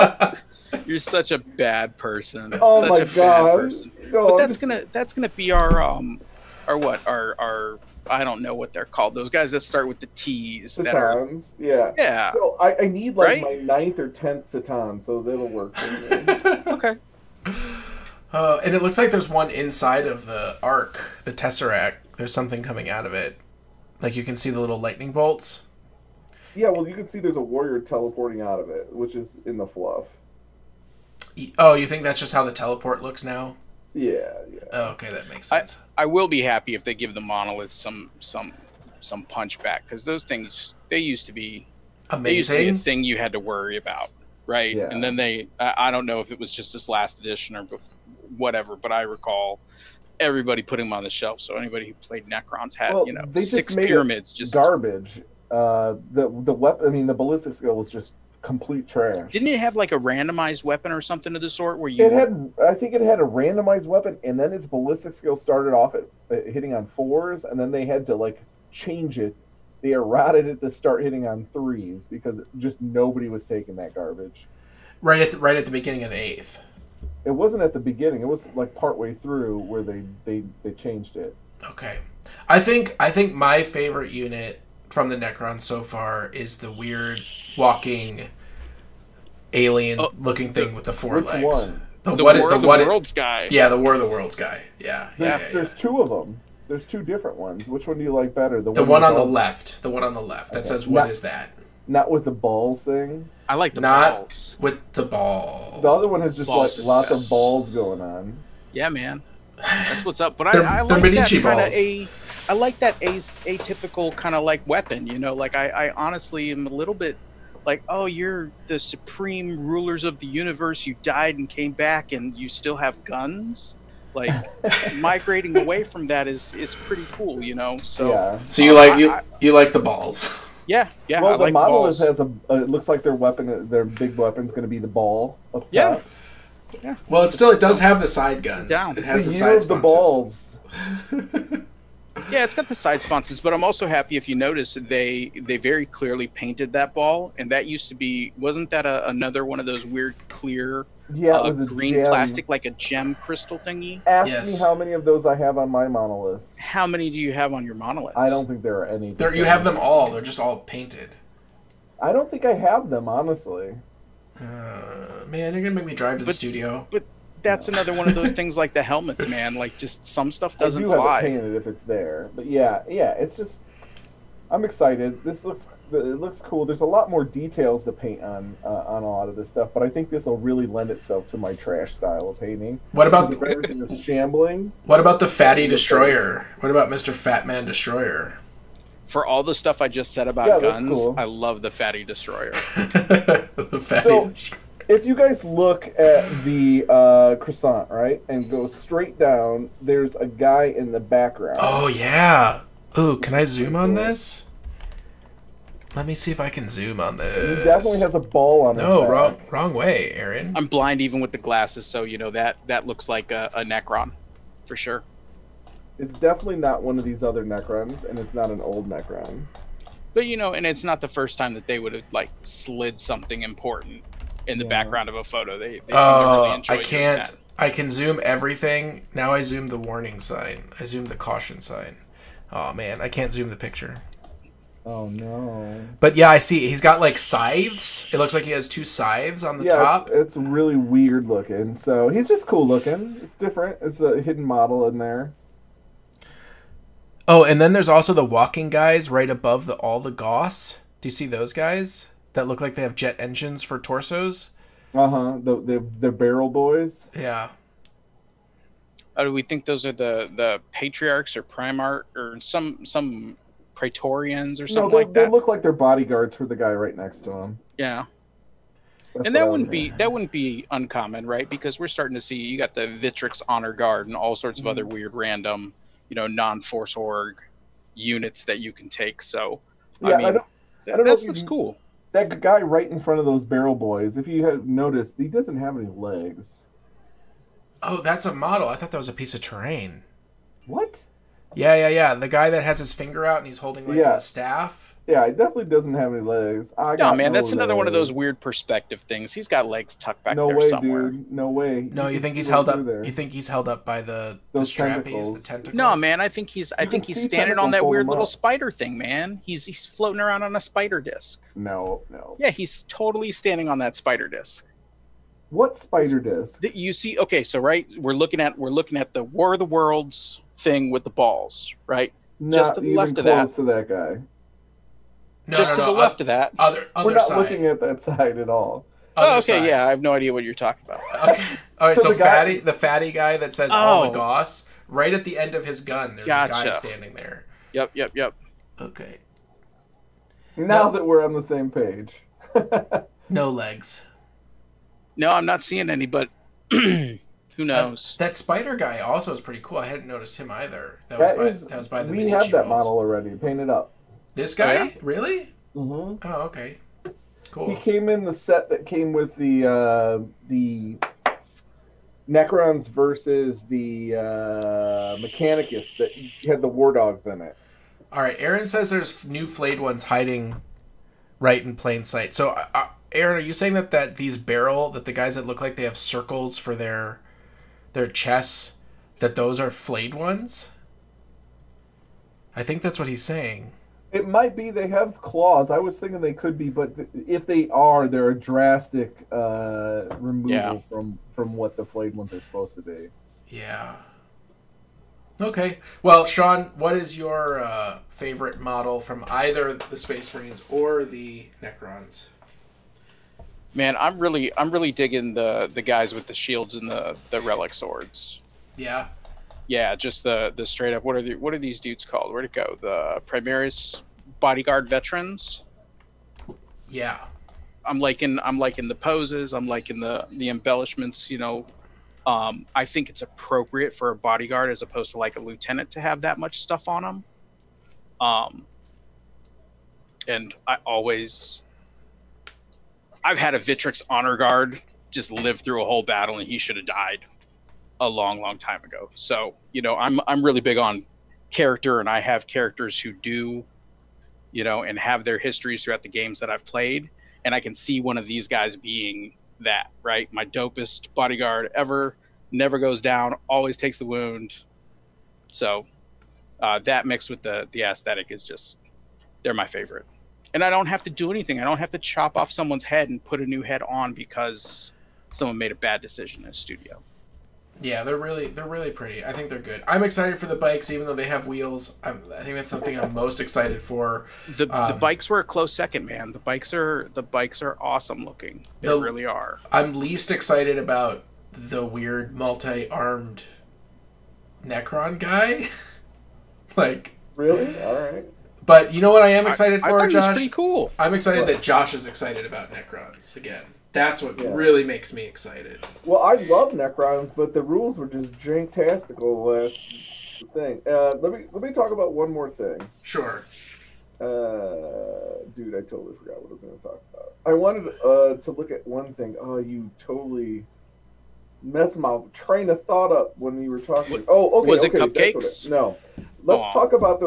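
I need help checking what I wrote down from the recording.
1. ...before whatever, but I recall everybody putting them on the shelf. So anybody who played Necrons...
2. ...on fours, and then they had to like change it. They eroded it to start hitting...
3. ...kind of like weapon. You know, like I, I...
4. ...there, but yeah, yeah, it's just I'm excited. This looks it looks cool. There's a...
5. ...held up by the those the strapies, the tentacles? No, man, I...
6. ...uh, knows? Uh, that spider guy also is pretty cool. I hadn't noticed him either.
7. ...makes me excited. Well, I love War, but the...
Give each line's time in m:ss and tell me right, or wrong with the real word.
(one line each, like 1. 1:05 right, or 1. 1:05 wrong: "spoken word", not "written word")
1. 0:47 right
2. 1:06 right
3. 1:54 right
4. 2:51 right
5. 5:03 right
6. 5:47 right
7. 8:14 wrong: "Necrons", not "War".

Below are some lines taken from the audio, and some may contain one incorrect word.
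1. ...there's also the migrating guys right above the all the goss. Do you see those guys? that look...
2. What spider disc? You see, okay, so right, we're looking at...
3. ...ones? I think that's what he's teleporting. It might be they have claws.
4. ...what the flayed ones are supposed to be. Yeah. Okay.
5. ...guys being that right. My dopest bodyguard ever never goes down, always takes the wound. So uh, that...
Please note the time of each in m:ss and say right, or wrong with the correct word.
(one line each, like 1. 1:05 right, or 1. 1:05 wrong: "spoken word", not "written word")
1. 4:07 wrong: "walking", not "migrating"
2. 5:15 right
3. 6:20 wrong: "saying", not "teleporting"
4. 6:31 right
5. 7:28 right.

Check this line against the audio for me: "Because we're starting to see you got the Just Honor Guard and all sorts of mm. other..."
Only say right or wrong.
wrong.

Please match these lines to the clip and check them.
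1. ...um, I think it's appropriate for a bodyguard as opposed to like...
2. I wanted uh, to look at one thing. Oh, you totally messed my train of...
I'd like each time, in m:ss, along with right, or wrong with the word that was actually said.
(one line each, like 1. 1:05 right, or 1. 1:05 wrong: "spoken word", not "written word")
1. 7:02 right
2. 8:27 right.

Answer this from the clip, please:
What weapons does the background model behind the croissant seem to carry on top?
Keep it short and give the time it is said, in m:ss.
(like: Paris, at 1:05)
Two scythes, at 3:58.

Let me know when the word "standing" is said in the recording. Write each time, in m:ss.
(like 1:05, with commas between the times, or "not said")
5:07, 5:13, 5:36.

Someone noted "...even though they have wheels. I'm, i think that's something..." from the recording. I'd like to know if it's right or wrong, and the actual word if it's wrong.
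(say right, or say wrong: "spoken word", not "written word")
right.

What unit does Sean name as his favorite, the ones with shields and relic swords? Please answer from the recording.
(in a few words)
Primaris bodyguard veterans.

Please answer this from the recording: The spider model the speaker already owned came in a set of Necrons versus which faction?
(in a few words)
Mechanicus.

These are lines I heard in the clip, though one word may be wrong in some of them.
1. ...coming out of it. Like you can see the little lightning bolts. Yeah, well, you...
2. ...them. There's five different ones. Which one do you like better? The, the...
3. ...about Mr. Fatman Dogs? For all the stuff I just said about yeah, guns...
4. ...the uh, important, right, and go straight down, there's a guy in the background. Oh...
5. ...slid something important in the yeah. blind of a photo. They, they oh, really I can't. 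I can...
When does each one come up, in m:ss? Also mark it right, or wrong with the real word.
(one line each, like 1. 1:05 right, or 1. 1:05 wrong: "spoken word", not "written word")
1. 0:22 right
2. 1:36 wrong: "two", not "five"
3. 3:06 wrong: "Destroyer", not "Dogs"
4. 3:16 wrong: "croissant", not "important"
5. 3:42 wrong: "background", not "blind".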